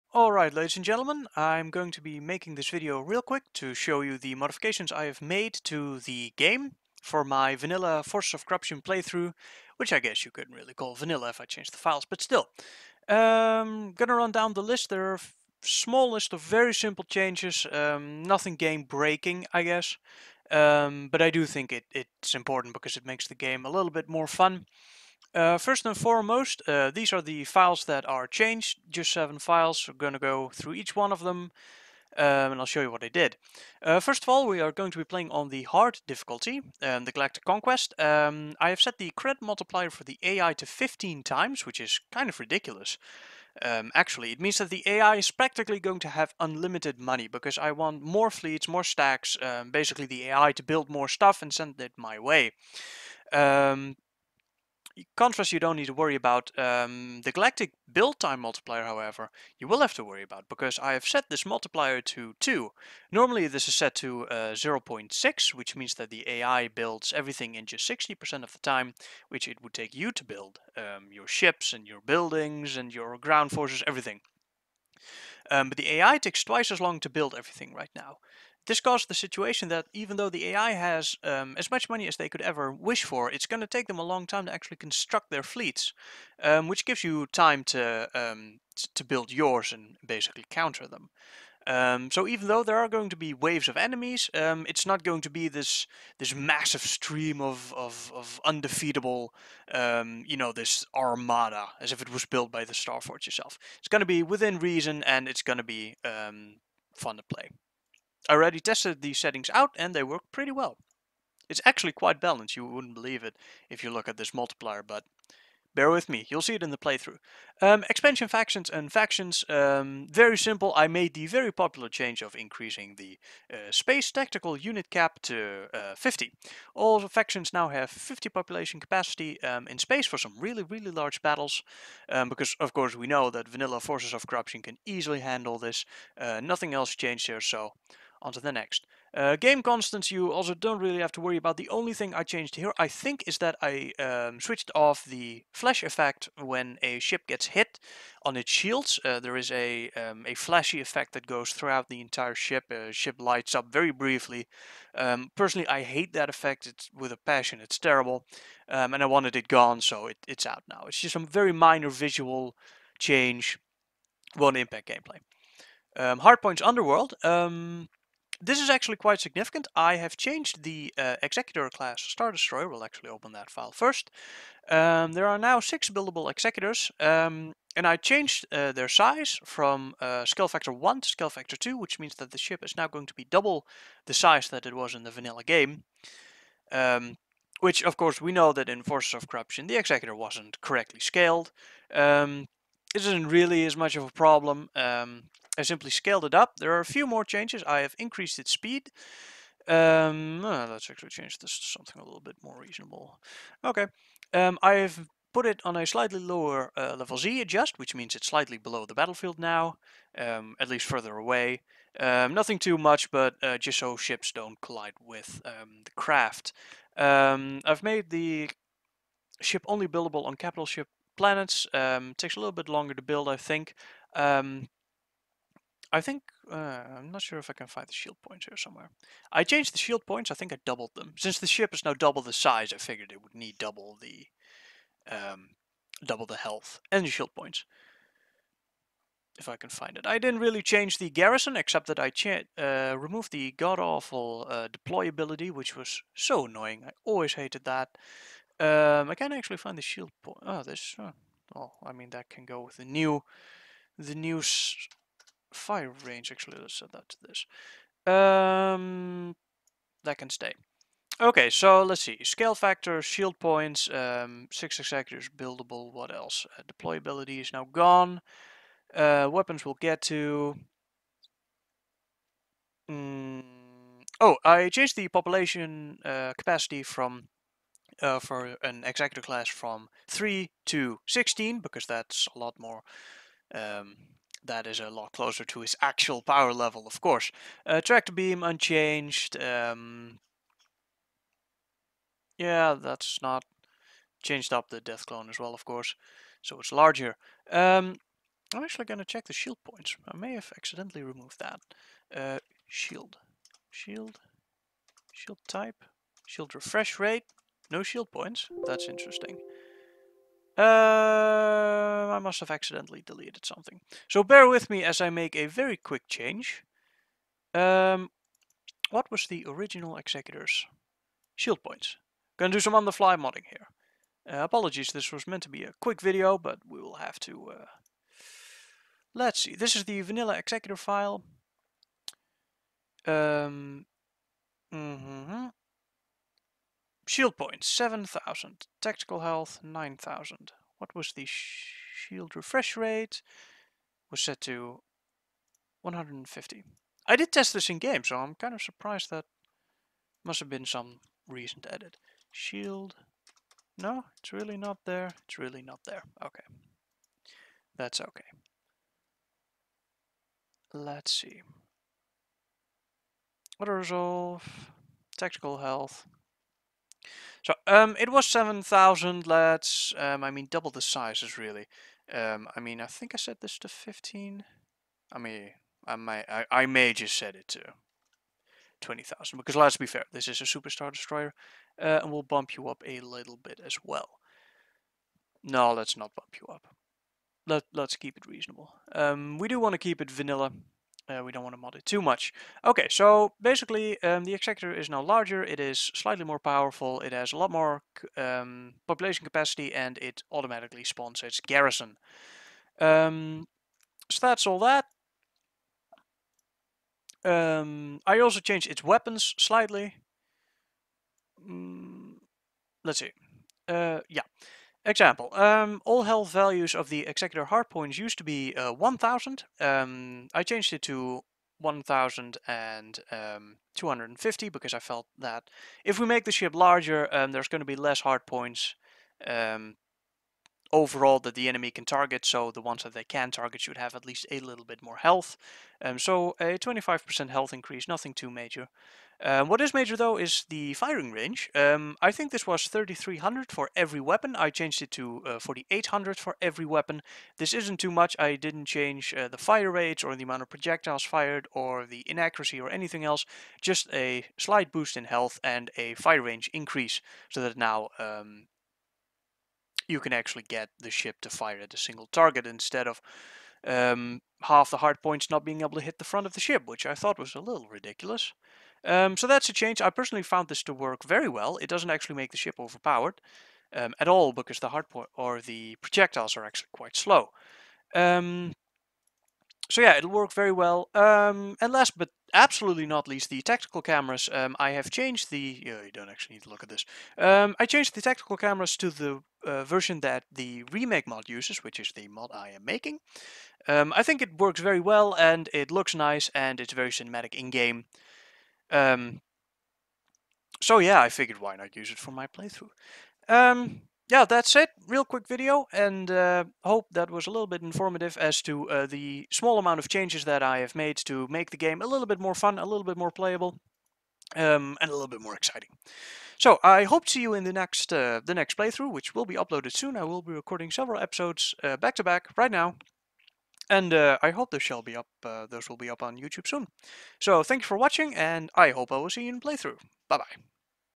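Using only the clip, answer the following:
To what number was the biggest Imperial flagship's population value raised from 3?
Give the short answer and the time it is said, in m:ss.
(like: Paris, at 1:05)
16, at 4:40.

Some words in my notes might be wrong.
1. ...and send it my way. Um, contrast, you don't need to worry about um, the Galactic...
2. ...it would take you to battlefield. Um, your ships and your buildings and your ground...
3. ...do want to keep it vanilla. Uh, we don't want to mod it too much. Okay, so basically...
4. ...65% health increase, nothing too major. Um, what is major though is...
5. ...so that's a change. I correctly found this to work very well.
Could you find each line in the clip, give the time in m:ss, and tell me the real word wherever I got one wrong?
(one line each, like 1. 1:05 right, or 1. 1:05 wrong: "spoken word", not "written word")
1. 0:51 right
2. 1:09 wrong: "build", not "battlefield"
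3. 6:29 right
4. 7:16 wrong: "25", not "65"
5. 7:49 wrong: "personally", not "correctly".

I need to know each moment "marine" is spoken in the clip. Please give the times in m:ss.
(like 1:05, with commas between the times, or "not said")
not said.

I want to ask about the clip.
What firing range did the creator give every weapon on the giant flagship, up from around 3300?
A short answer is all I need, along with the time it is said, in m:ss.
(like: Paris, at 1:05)
4800, at 7:25.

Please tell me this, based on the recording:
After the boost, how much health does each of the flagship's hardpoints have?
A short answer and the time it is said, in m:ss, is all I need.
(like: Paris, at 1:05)
1250, at 7:01.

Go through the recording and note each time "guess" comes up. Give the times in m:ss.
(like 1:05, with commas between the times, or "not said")
0:09, 0:19.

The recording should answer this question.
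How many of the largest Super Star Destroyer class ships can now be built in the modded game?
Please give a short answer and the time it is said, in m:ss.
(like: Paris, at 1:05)
six, at 2:55.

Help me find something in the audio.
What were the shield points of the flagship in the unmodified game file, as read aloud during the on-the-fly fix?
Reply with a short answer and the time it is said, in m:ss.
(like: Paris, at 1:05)
7,000, at 5:37.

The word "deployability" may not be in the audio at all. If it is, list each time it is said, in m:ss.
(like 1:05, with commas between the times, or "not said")
4:04, 4:26.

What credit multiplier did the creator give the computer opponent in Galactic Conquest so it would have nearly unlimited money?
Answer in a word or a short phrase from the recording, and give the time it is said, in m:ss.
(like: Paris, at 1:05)
15 times, at 0:40.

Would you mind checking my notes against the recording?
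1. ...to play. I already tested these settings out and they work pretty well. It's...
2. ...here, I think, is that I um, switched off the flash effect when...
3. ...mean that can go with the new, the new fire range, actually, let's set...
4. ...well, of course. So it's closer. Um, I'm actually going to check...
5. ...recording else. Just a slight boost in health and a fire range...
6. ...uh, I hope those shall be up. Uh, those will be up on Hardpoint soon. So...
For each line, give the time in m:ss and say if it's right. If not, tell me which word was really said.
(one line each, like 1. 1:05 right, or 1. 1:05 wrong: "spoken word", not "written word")
1. 1:47 right
2. 2:22 right
3. 4:11 right
4. 4:55 wrong: "larger", not "closer"
5. 7:32 wrong: "anything", not "recording"
6. 8:43 wrong: "YouTube", not "Hardpoint".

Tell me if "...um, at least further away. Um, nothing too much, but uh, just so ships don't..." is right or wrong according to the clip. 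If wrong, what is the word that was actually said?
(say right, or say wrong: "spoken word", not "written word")
right.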